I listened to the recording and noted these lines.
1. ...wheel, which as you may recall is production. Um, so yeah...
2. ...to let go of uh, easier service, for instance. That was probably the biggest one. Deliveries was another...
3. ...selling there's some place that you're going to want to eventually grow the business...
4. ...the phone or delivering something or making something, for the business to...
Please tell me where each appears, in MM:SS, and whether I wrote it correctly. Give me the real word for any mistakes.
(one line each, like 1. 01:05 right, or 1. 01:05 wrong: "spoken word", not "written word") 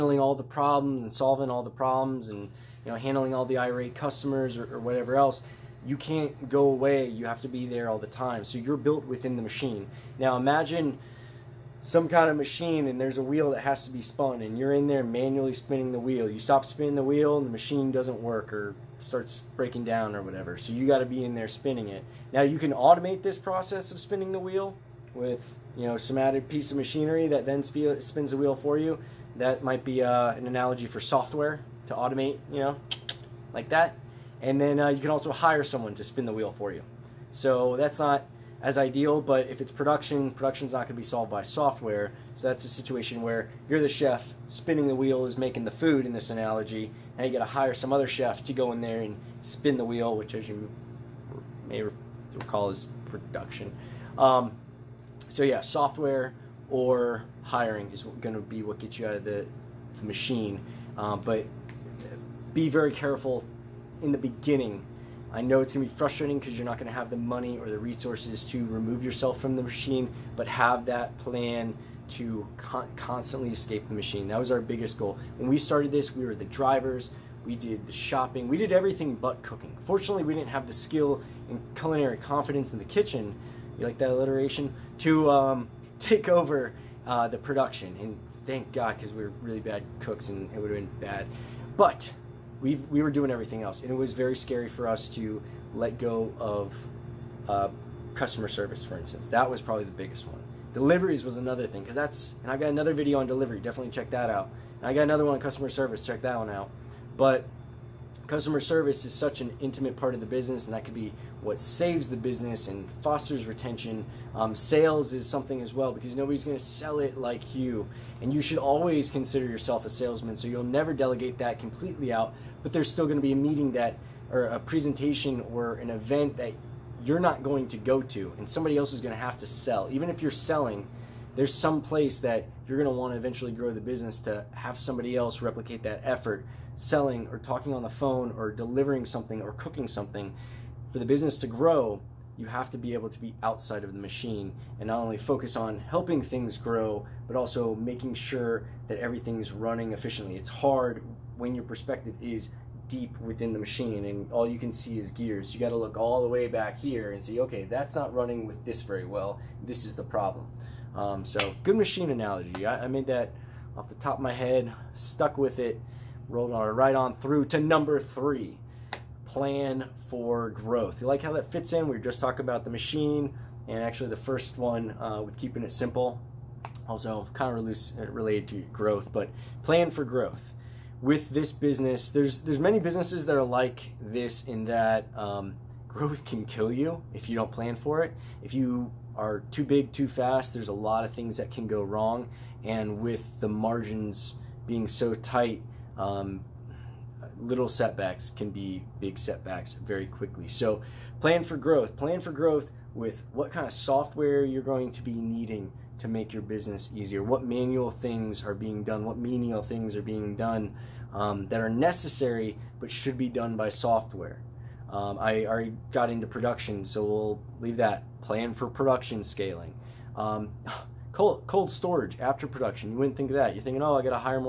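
1. 00:49 right
2. 01:35 wrong: "customer", not "easier"
3. 02:10 right
4. 02:17 wrong: "cooking", not "making".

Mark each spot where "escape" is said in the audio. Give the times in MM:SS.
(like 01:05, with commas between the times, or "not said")
01:13.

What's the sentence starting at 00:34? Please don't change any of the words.
And then uh, you can also hire someone to spin the wheel for you.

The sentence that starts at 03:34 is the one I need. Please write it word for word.
Um, I already got into production, so we'll leave that.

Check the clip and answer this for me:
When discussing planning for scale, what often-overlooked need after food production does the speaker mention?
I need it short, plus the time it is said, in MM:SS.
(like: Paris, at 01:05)
cold storage, at 03:41.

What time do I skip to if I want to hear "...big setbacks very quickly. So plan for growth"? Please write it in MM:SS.
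03:18.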